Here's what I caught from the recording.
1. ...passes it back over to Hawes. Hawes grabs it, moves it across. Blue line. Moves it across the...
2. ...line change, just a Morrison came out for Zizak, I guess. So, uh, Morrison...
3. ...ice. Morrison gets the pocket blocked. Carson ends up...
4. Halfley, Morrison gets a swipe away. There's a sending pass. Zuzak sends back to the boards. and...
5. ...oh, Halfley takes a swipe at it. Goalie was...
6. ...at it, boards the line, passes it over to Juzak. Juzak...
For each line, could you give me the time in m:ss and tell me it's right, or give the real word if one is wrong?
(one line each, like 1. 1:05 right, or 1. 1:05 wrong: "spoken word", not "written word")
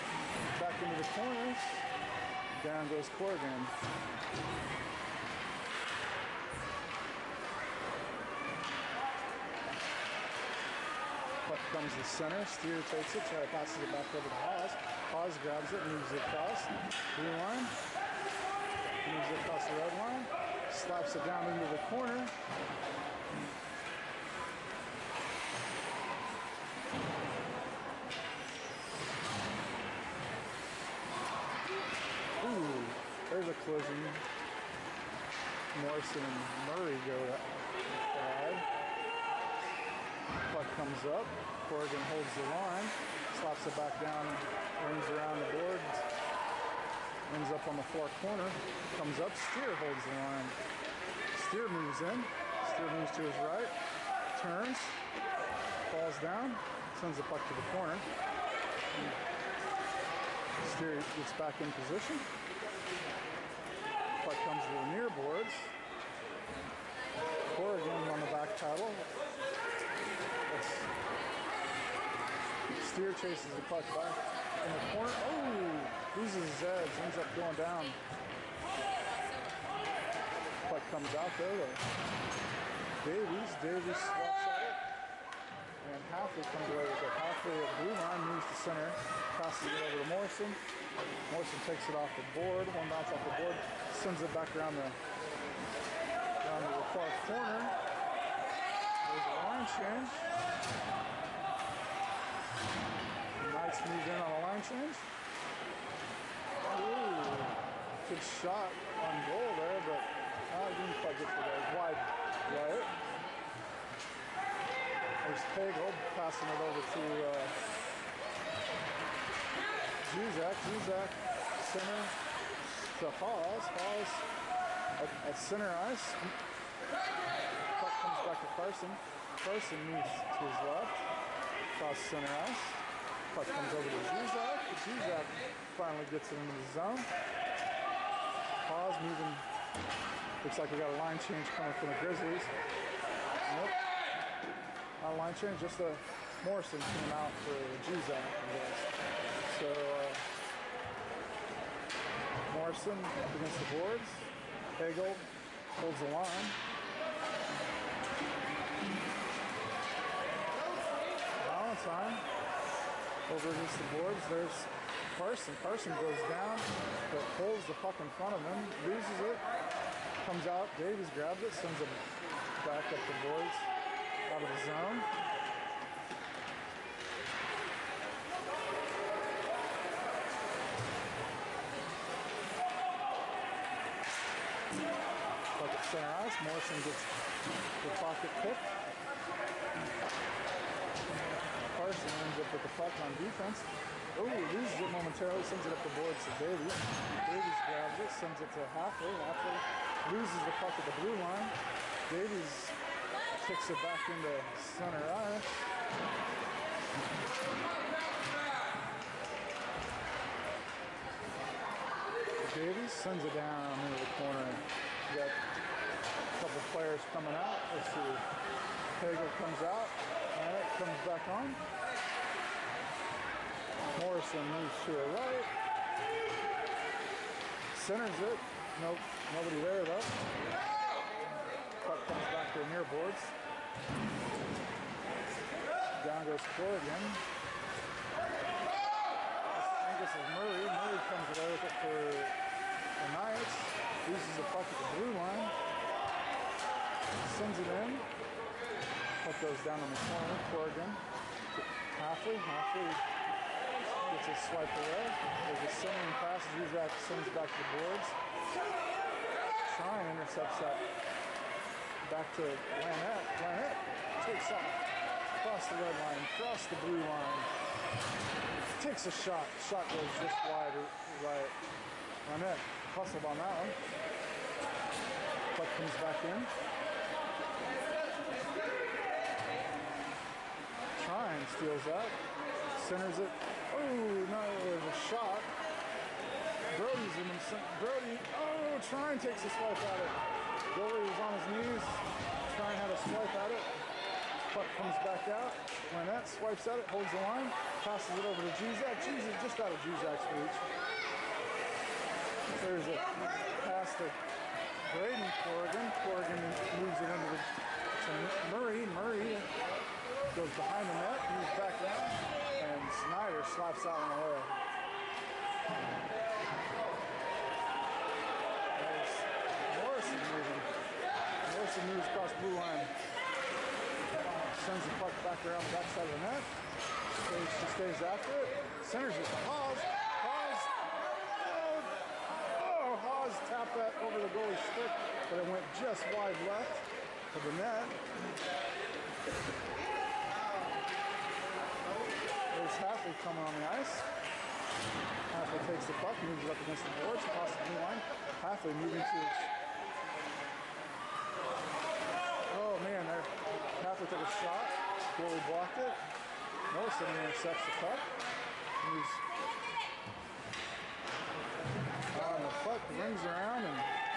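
1. 0:13 right
2. 2:25 right
3. 3:06 wrong: "picked", not "blocked"
4. 4:12 wrong: "Halfley", not "Morrison"
5. 4:48 wrong: "Trine", not "Halfley"
6. 4:56 wrong: "holds", not "boards".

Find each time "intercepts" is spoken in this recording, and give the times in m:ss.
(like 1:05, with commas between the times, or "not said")
4:20, 5:57.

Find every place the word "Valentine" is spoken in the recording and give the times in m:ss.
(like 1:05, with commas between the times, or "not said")
2:41.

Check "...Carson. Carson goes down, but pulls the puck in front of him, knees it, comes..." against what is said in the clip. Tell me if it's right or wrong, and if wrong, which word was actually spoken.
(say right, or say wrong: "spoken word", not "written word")
wrong: "loses", not "knees".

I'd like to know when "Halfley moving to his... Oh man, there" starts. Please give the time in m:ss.
5:48.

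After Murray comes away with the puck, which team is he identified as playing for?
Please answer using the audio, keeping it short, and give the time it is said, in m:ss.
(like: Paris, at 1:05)
Knights, at 4:03.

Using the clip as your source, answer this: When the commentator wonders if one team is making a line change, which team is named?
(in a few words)
Grizzlies.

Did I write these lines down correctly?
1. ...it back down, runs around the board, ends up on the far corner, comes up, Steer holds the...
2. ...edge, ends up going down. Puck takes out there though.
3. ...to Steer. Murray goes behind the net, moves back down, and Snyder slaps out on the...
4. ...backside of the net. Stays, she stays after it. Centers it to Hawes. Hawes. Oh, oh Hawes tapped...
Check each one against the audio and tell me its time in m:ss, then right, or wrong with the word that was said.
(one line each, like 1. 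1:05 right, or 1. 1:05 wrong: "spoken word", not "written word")
1. 0:43 right
2. 1:16 wrong: "comes", not "takes"
3. 5:07 wrong: "Murray", not "Steer"
4. 5:25 right.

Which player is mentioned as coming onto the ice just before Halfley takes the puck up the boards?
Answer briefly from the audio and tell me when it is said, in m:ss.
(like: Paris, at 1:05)
Buckley, at 5:42.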